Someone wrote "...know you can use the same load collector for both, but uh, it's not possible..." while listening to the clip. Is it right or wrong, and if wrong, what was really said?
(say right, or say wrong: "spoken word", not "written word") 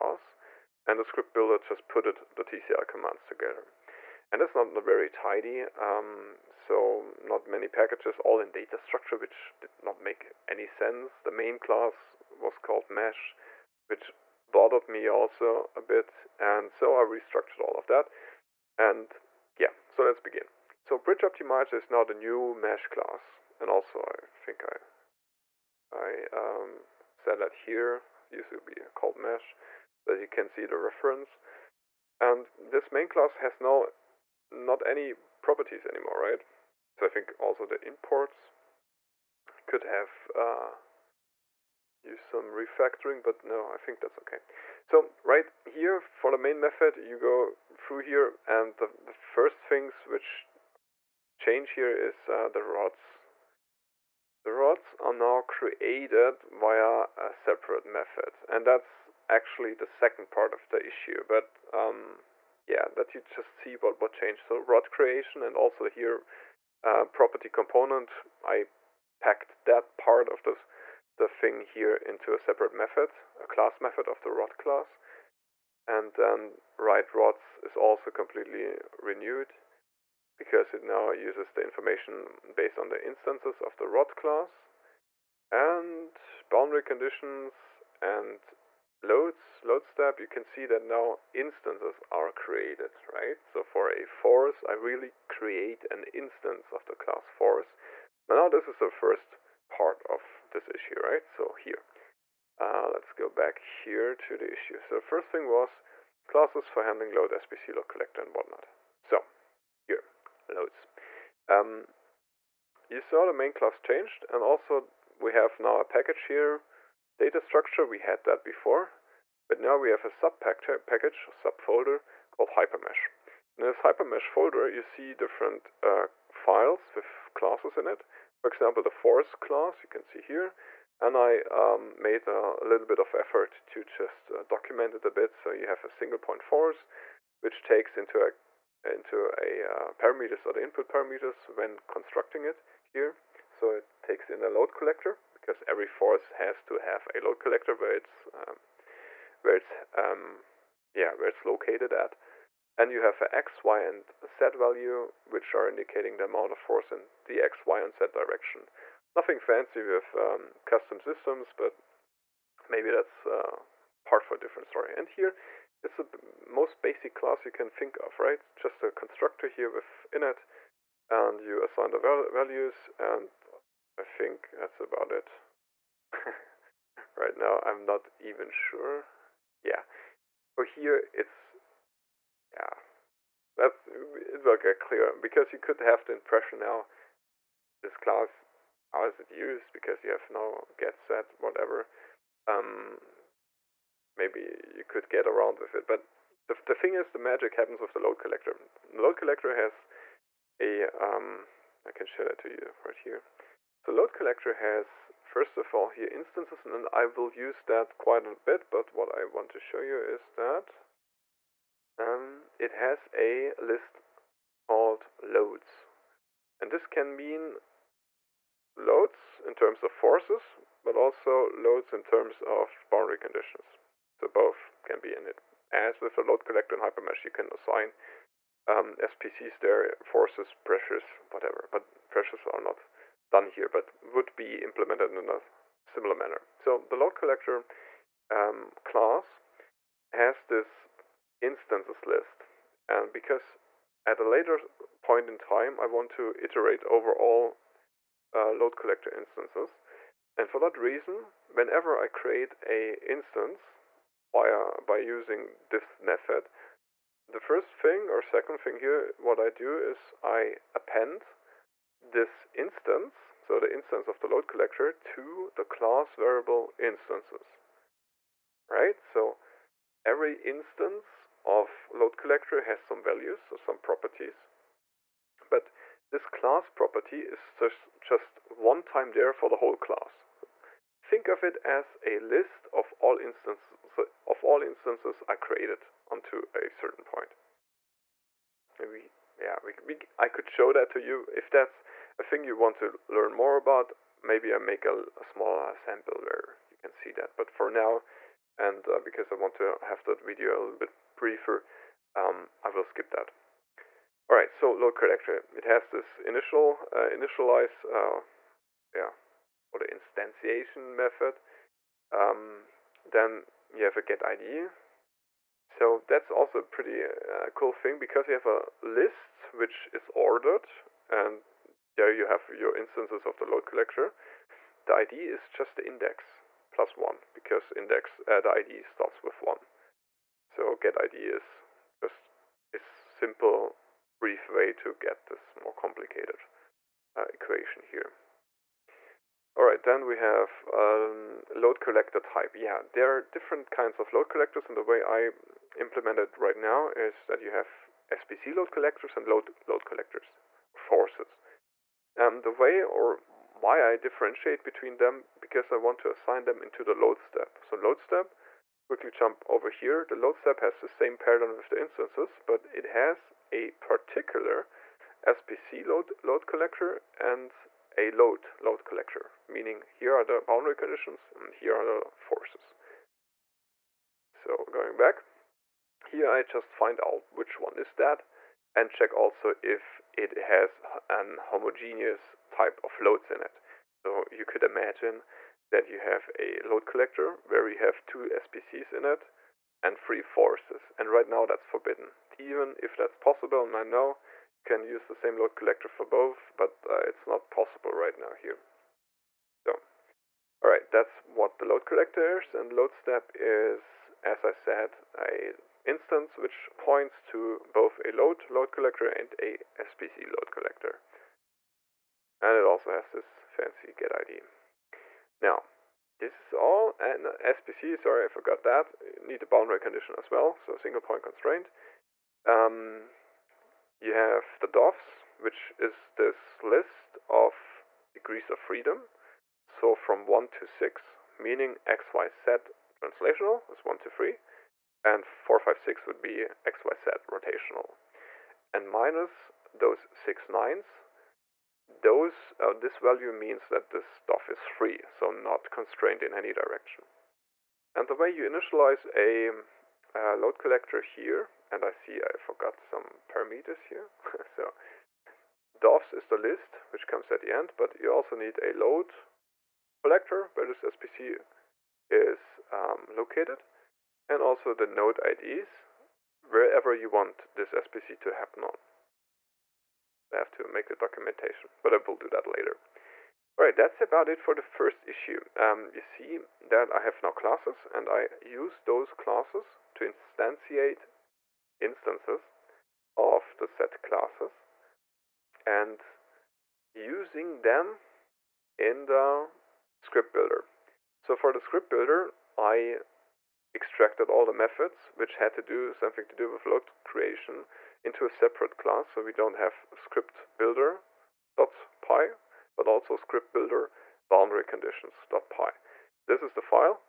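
right.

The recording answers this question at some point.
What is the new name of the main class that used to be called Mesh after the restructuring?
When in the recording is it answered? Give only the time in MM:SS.
00:20.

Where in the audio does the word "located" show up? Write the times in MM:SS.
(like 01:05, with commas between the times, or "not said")
02:31, 07:43.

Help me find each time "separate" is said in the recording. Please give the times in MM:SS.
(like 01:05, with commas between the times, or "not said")
00:57, 01:12, 08:18.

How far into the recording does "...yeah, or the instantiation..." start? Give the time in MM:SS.
05:08.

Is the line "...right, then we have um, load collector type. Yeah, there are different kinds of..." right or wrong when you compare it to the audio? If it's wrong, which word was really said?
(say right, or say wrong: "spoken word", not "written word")
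right.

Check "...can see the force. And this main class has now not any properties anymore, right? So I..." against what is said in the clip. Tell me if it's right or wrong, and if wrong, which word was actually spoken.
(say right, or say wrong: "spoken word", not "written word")
wrong: "reference", not "force".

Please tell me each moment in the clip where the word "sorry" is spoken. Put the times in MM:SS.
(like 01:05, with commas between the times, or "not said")
06:57.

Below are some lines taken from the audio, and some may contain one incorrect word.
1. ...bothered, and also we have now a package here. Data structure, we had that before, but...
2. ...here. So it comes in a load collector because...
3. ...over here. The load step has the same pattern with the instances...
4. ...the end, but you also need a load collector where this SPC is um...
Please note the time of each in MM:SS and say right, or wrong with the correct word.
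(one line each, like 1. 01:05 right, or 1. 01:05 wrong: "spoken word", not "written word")
1. 01:53 wrong: "changed", not "bothered"
2. 02:22 wrong: "takes", not "comes"
3. 05:59 right
4. 07:37 right.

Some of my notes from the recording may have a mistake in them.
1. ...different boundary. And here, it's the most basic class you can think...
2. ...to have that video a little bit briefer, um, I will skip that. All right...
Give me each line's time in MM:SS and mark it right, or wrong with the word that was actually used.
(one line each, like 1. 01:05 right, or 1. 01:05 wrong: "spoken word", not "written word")
1. 02:44 wrong: "story", not "boundary"
2. 04:59 right.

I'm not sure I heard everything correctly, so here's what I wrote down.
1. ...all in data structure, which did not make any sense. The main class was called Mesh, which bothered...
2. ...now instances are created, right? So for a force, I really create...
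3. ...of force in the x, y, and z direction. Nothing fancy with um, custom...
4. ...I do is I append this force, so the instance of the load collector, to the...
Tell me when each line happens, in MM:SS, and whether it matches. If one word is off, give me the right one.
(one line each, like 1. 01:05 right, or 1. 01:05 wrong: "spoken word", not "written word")
1. 00:08 right
2. 01:30 right
3. 02:36 right
4. 04:19 wrong: "instance", not "force".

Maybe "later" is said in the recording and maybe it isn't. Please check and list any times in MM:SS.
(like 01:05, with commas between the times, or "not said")
04:04, 07:52.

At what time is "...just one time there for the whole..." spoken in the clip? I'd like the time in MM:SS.
04:37.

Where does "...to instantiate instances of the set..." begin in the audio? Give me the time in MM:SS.
07:59.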